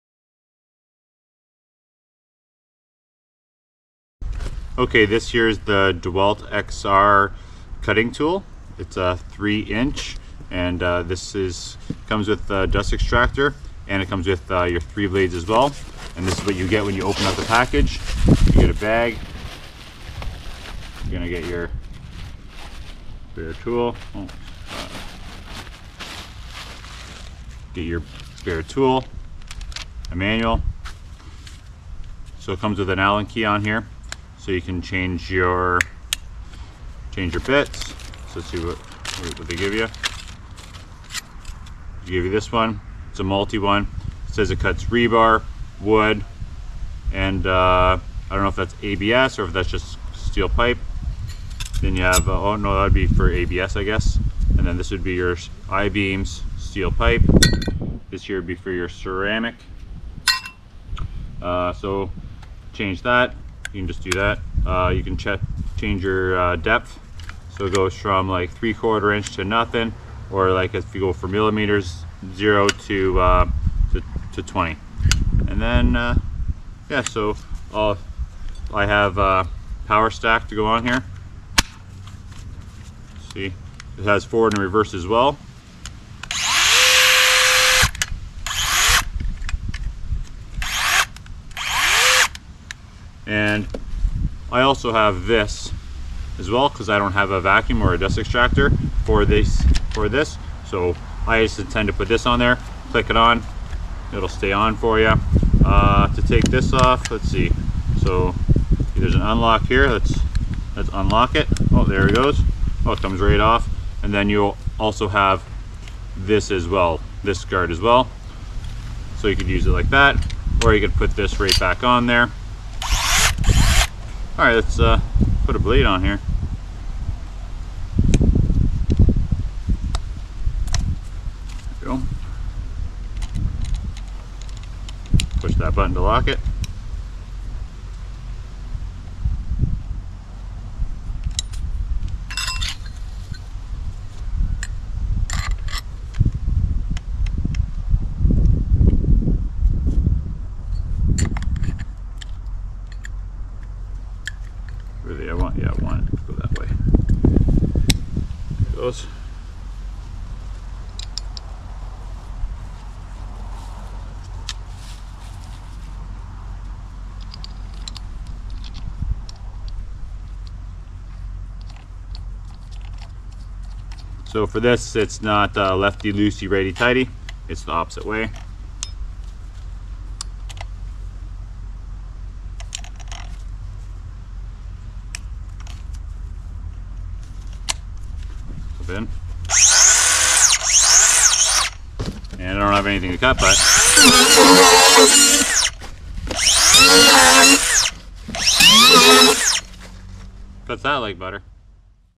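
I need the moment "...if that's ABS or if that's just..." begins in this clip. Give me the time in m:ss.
0:48.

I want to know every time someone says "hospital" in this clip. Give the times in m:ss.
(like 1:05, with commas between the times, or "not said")
not said.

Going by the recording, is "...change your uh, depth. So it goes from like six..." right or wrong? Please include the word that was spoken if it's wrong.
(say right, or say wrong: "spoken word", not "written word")
wrong: "three", not "six".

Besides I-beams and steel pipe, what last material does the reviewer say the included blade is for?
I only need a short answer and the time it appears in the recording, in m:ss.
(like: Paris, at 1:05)
ceramic, at 0:58.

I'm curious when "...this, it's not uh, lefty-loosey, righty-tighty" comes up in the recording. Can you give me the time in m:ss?
2:54.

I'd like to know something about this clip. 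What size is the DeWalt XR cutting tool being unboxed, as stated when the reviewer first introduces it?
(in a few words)
3 inch.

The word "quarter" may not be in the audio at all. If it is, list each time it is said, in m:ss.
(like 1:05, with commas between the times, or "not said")
1:08.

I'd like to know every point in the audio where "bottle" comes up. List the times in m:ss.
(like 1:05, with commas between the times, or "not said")
not said.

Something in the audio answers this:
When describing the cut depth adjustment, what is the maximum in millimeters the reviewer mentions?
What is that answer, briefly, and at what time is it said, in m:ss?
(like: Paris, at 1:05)
20, at 1:14.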